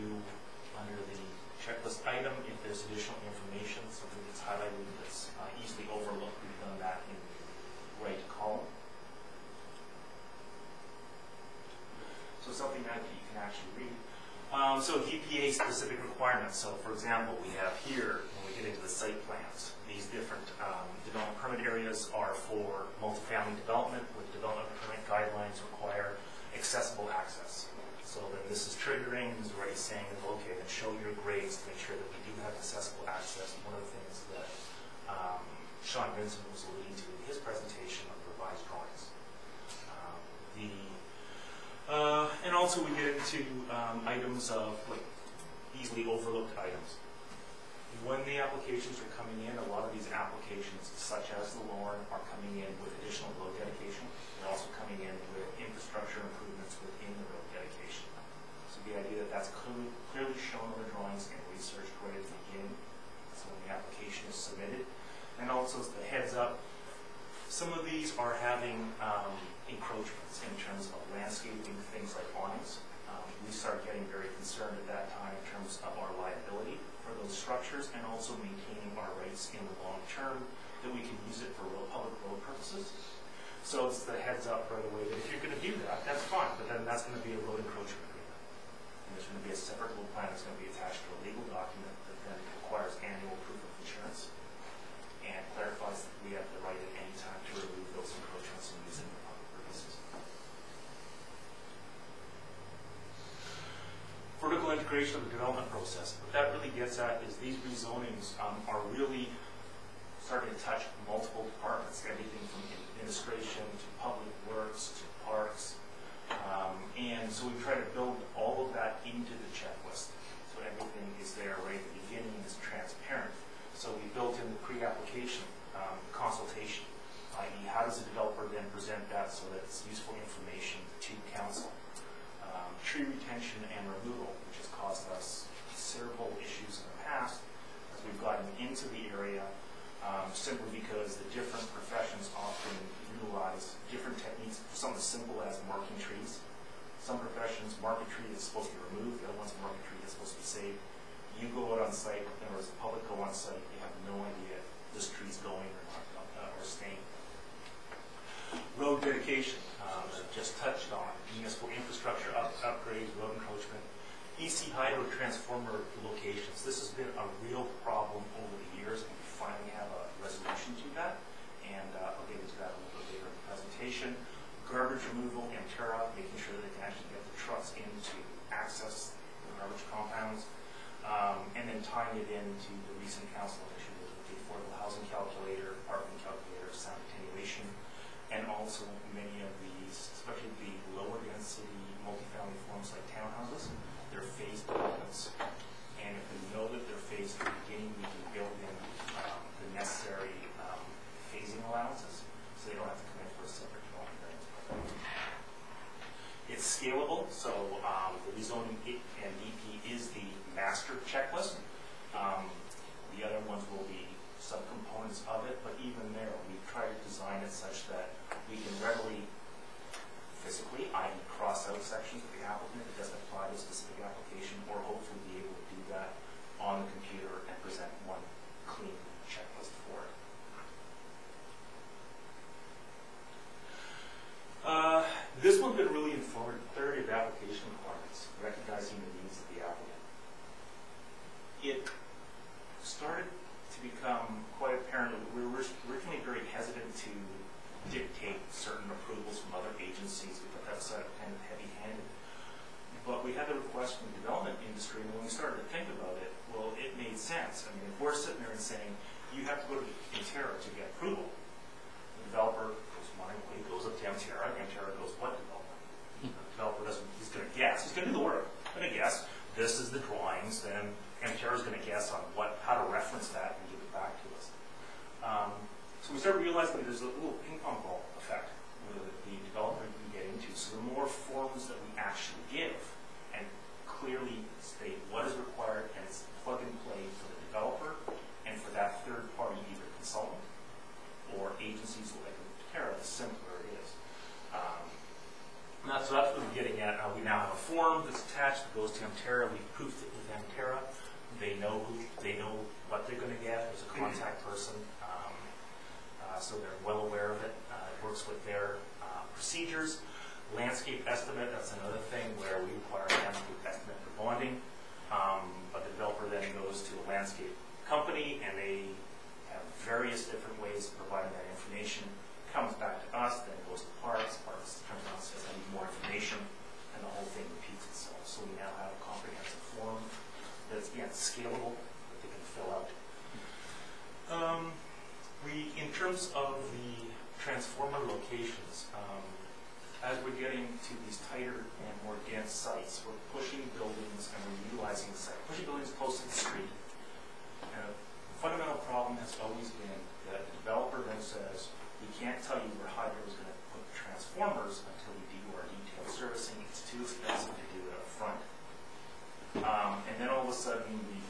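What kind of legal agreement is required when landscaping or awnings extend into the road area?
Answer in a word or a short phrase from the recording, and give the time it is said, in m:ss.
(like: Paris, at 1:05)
road encroachment agreement, at 1:27.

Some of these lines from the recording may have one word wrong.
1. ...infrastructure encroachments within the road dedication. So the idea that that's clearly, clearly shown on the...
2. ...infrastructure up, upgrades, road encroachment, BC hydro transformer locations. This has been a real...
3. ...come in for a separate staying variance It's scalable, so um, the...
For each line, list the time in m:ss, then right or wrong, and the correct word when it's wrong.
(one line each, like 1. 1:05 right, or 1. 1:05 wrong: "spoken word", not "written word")
1. 0:55 wrong: "improvements", not "encroachments"
2. 2:41 right
3. 3:23 wrong: "dwelling", not "staying".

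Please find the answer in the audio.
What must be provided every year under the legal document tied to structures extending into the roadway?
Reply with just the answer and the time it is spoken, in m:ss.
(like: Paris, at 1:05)
proof of insurance, at 1:33.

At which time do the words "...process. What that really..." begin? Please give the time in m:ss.
1:45.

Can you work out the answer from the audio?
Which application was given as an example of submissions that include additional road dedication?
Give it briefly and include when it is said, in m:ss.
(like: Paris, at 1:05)
the Lorne, at 0:51.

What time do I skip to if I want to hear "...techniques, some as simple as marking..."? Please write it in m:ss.
2:24.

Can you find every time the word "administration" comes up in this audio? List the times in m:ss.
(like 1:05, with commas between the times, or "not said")
1:52.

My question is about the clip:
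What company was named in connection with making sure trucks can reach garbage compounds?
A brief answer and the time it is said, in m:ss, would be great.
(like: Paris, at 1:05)
Emterra, at 2:55.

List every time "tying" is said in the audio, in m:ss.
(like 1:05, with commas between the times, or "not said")
3:01.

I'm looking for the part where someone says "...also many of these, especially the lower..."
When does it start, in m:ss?
3:08.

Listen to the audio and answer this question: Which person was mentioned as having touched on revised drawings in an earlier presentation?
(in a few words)
Sean Vincent.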